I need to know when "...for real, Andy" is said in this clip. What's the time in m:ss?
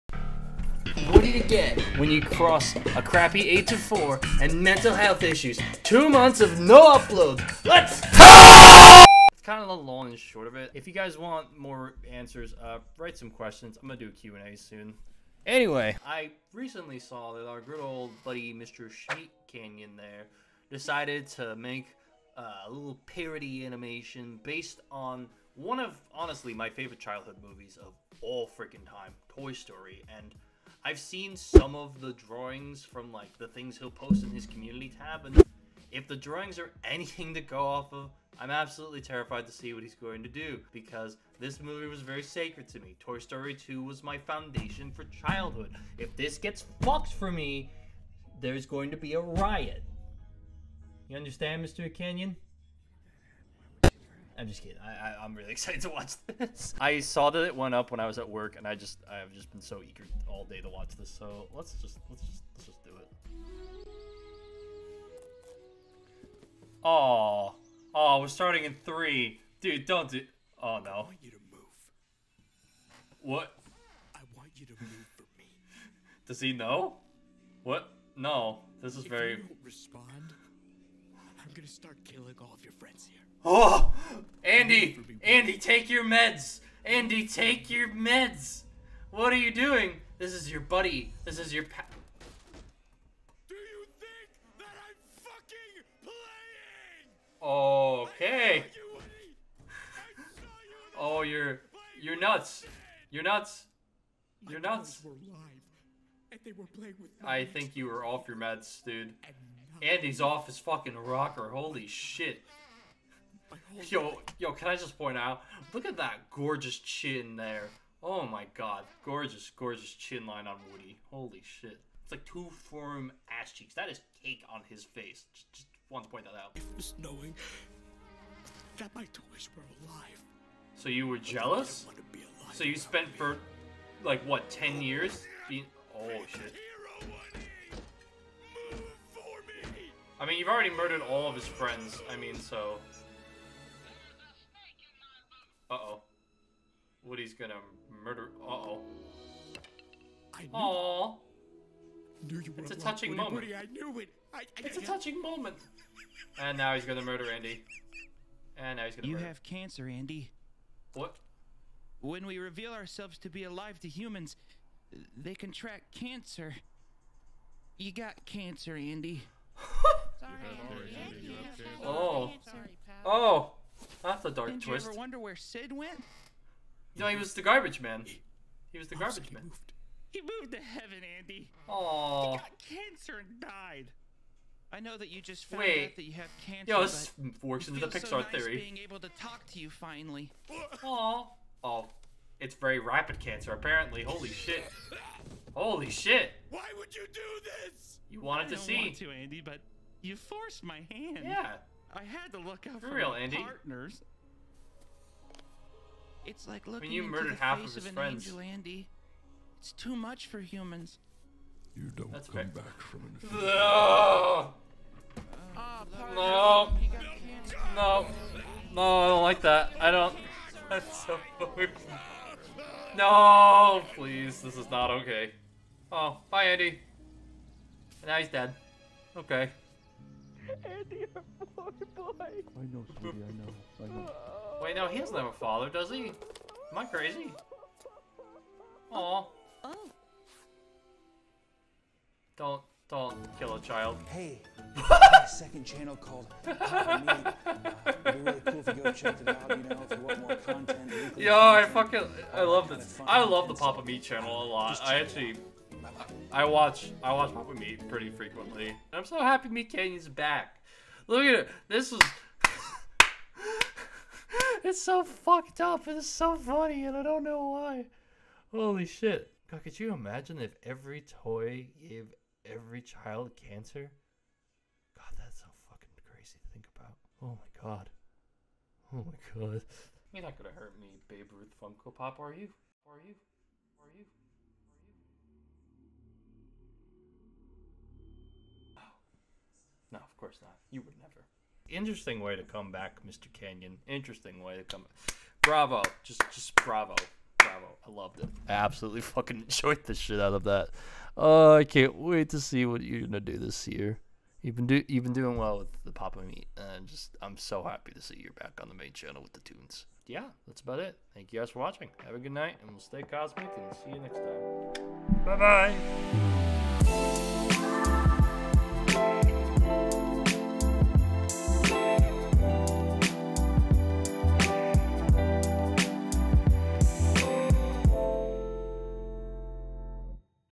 3:22.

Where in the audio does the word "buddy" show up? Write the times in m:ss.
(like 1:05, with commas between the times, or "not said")
0:18, 1:30.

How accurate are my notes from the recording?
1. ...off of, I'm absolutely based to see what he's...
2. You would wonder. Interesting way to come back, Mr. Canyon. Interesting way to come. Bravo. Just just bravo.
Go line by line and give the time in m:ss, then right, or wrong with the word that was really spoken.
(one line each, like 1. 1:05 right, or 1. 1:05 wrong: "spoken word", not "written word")
1. 0:37 wrong: "terrified", not "based"
2. 4:50 wrong: "never", not "wonder".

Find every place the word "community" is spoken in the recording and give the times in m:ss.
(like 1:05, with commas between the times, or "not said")
0:34.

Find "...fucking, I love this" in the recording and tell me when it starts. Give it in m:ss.
4:11.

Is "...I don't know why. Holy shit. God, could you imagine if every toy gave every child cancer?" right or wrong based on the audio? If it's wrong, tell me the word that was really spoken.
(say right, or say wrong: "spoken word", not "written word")
right.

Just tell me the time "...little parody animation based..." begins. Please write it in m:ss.
0:22.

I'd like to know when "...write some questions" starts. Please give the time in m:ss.
0:12.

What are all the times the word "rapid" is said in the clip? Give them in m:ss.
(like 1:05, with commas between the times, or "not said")
3:12.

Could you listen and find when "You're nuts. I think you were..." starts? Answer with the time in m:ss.
1:44.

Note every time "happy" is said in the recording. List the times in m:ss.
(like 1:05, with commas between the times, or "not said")
4:19, 5:07.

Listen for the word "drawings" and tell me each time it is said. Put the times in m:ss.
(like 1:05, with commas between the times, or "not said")
0:32, 0:36.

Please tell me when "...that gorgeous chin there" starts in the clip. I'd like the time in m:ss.
1:55.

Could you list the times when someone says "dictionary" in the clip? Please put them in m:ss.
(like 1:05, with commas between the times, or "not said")
not said.